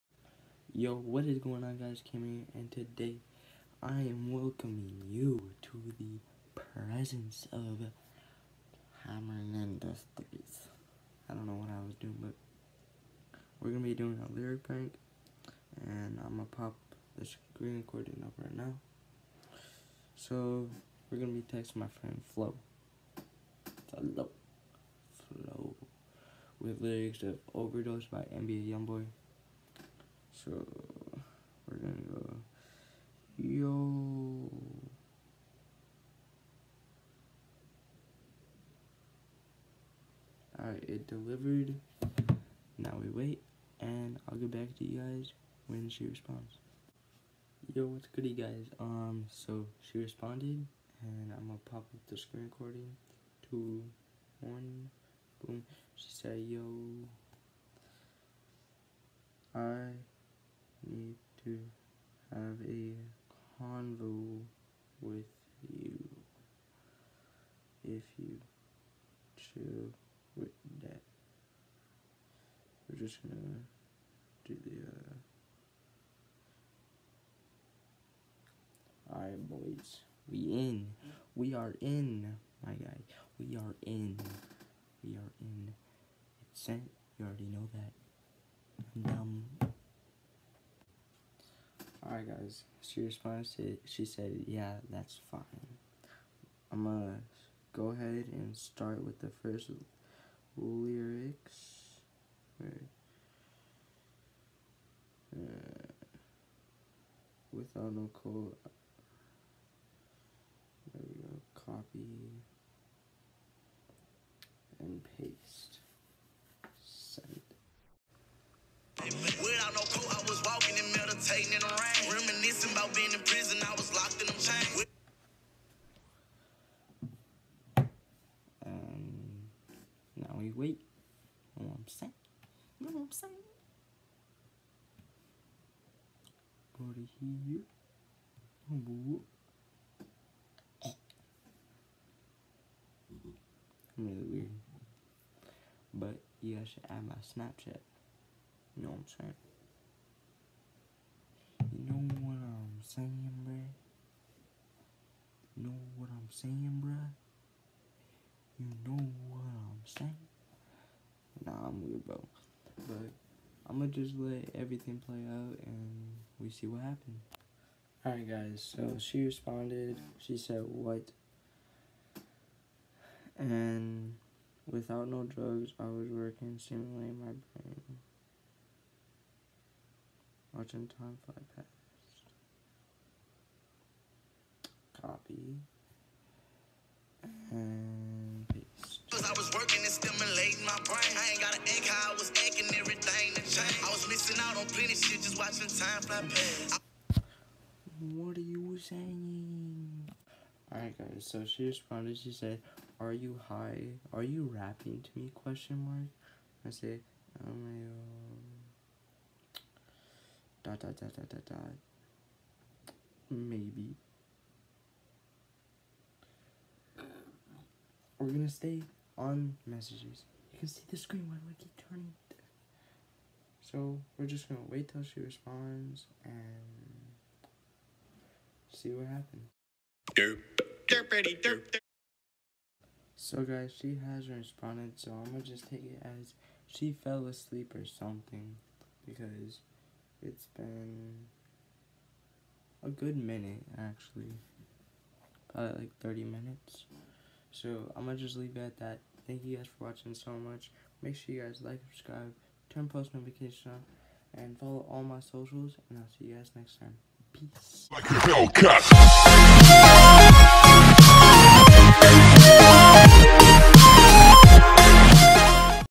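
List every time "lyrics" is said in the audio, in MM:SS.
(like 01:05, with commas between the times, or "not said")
00:14, 00:26, 01:40.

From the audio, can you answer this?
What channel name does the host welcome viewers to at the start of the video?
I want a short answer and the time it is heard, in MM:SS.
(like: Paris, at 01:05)
Hammering Industries, at 00:09.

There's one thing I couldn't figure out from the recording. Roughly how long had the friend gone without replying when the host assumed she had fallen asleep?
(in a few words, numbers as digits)
30 minutes.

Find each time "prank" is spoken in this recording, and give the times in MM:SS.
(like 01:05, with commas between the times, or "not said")
00:14.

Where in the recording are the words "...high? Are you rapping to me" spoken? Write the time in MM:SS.
03:23.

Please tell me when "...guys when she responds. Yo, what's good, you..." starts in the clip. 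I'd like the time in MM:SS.
00:44.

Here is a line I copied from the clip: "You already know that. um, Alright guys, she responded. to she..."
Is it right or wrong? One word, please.
right.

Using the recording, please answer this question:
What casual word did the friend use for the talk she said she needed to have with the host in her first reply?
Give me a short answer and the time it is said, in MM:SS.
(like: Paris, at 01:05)
convo, at 01:03.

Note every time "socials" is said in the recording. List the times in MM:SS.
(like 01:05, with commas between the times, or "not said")
04:15.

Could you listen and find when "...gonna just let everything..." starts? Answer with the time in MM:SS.
02:43.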